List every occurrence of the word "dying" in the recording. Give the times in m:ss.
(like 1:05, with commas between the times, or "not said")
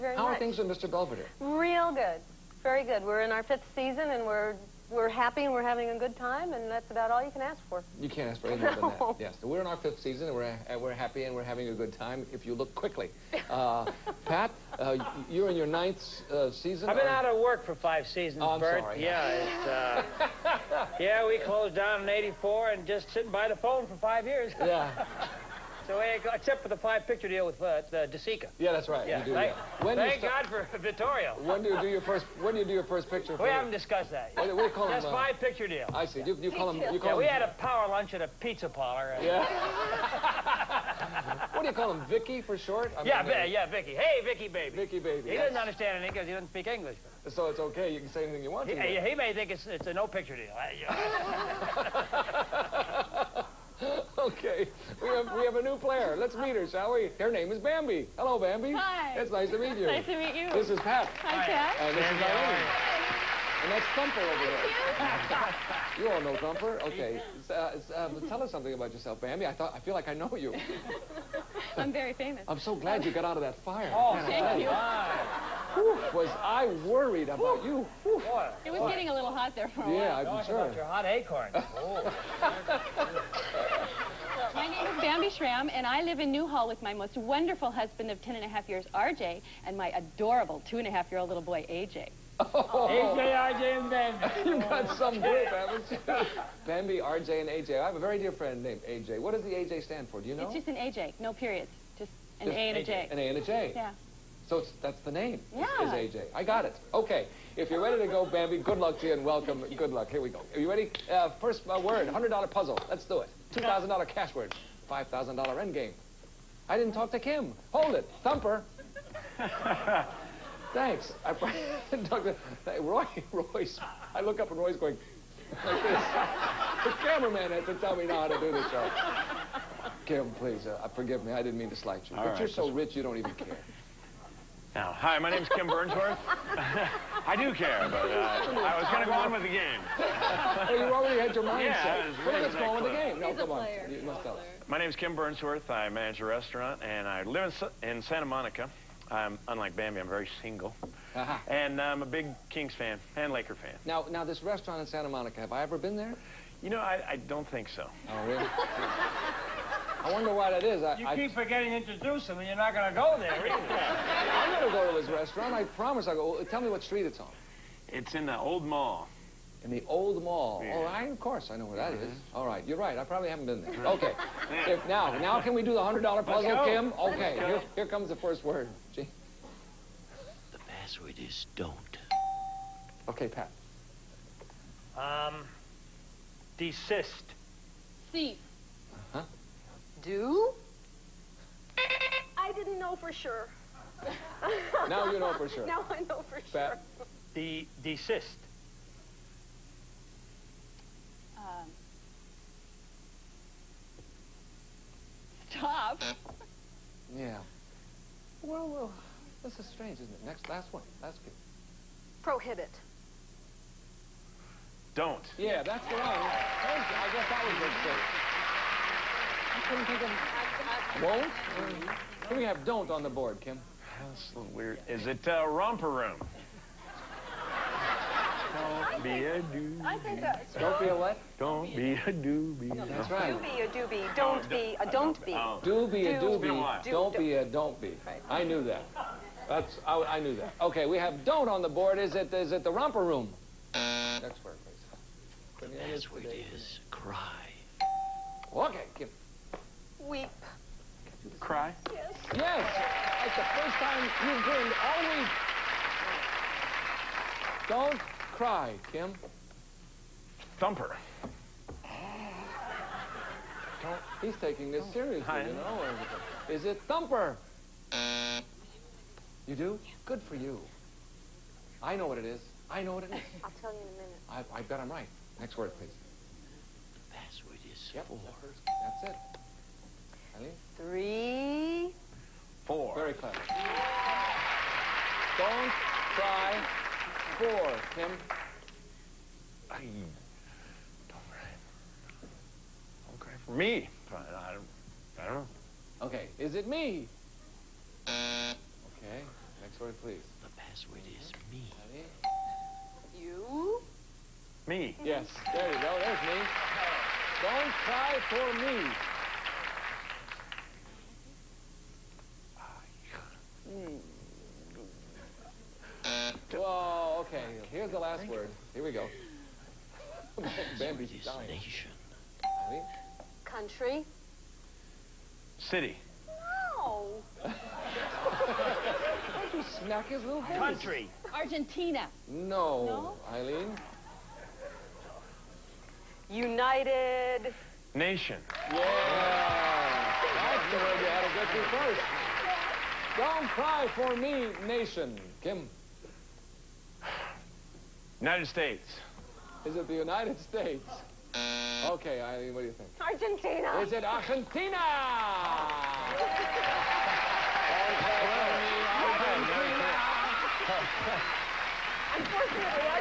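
5:21.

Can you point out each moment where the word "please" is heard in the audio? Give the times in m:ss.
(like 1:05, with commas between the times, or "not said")
2:10, 4:04, 4:35, 5:00.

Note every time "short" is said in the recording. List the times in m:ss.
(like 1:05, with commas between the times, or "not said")
0:42.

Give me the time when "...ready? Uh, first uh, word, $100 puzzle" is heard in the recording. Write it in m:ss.
1:50.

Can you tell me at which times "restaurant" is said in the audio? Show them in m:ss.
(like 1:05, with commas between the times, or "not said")
2:26, 2:34, 2:45.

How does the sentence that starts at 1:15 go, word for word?
Whew, was I worried about Whew.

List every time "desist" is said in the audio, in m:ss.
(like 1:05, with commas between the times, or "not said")
3:06, 3:17.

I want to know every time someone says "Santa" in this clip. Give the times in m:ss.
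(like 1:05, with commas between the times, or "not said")
2:28, 2:34.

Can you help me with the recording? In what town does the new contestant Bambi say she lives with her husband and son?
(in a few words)
Newhall.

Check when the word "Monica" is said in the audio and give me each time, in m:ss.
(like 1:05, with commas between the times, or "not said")
2:28, 2:35.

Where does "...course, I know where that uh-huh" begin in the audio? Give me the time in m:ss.
2:51.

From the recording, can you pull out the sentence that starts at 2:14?
Now, hi, my name's Kim Burnsworth.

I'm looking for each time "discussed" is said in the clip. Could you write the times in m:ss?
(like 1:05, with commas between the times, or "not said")
0:33.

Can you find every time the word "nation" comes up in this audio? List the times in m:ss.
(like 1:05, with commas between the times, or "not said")
5:21, 5:37, 5:44.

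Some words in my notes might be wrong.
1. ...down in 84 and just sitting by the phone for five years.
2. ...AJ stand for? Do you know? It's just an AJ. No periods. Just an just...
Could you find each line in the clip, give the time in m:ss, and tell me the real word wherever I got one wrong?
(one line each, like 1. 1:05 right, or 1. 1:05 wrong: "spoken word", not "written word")
1. 0:21 right
2. 1:39 right.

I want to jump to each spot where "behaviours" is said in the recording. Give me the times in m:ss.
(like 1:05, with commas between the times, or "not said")
not said.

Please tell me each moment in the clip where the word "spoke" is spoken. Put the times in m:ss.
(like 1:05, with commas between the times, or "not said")
not said.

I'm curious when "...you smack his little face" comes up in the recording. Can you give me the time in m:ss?
5:29.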